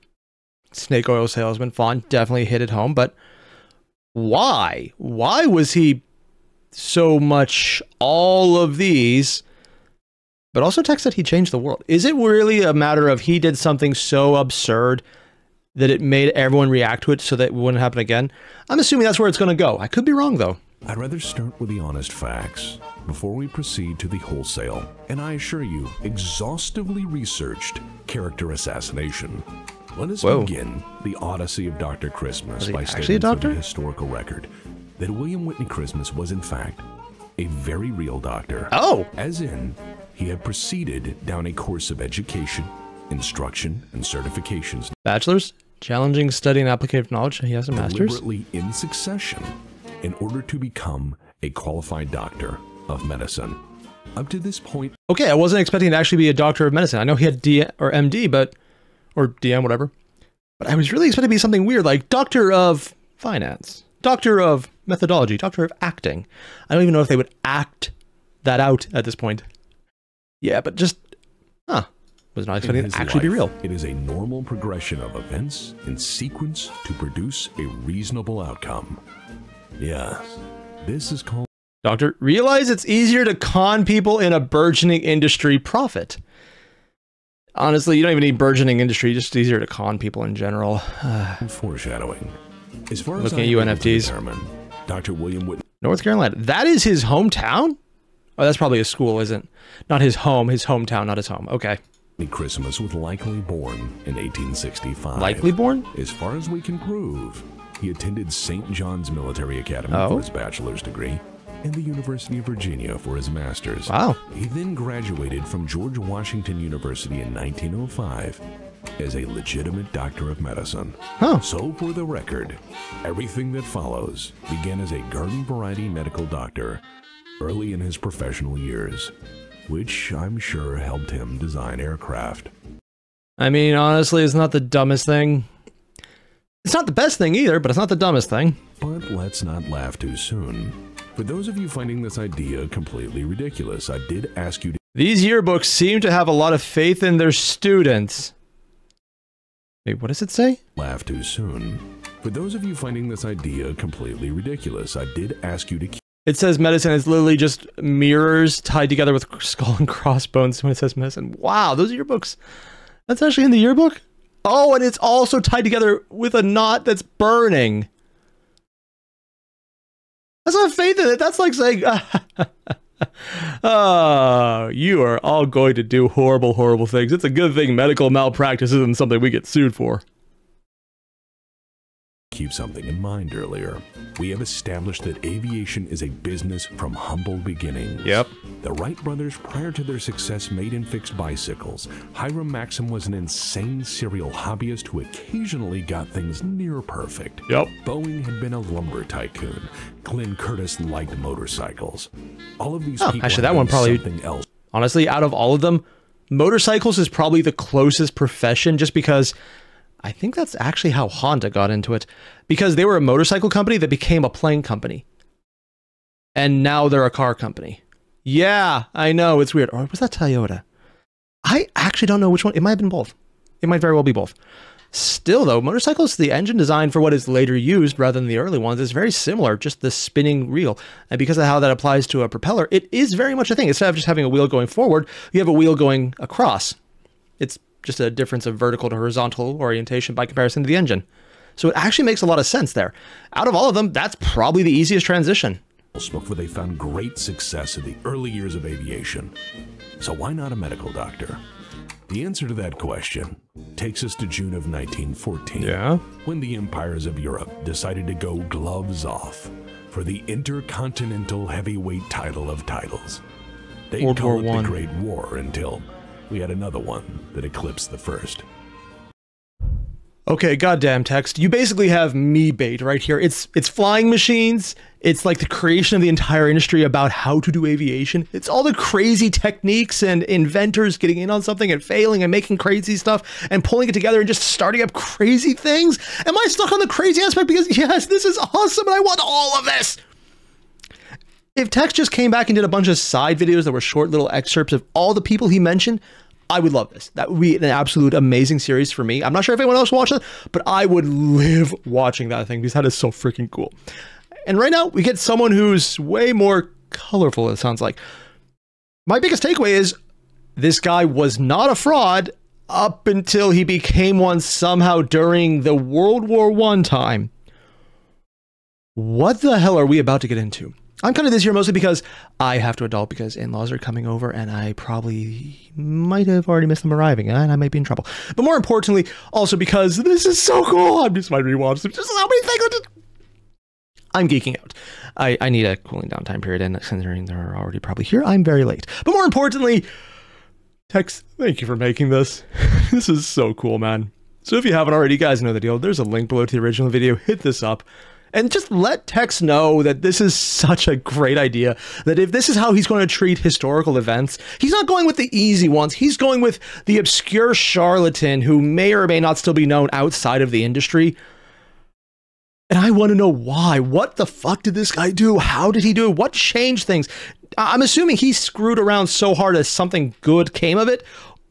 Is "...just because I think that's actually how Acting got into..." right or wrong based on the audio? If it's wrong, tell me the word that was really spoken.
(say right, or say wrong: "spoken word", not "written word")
wrong: "Honda", not "Acting".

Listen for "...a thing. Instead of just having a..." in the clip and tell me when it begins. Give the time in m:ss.
3:53.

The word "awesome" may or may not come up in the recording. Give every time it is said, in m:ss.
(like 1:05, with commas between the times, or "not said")
4:48.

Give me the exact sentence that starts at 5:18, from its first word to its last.
What the hell are we about to get into?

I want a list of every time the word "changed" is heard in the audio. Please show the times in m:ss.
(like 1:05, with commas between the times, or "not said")
0:11, 6:06.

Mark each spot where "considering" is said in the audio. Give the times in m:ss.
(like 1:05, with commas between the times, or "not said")
5:36.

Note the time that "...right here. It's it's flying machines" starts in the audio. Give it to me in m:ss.
4:32.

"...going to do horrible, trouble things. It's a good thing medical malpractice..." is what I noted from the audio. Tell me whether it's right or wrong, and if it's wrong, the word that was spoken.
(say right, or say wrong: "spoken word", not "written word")
wrong: "horrible", not "trouble".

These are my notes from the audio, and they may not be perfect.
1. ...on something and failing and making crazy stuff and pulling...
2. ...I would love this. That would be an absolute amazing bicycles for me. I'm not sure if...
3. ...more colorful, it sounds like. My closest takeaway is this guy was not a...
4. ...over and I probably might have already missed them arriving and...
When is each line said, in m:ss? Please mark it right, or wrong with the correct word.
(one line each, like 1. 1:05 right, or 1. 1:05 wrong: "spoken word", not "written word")
1. 4:41 right
2. 4:56 wrong: "series", not "bicycles"
3. 5:06 wrong: "biggest", not "closest"
4. 5:24 right.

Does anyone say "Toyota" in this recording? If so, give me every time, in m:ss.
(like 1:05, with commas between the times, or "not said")
3:40.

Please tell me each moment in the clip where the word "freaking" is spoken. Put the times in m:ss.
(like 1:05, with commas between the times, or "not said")
5:03.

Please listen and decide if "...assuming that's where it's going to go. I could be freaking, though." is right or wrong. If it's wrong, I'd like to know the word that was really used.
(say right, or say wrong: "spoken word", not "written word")
wrong: "wrong", not "freaking".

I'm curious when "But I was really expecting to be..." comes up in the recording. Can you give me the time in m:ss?
1:00.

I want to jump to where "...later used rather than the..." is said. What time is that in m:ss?
3:47.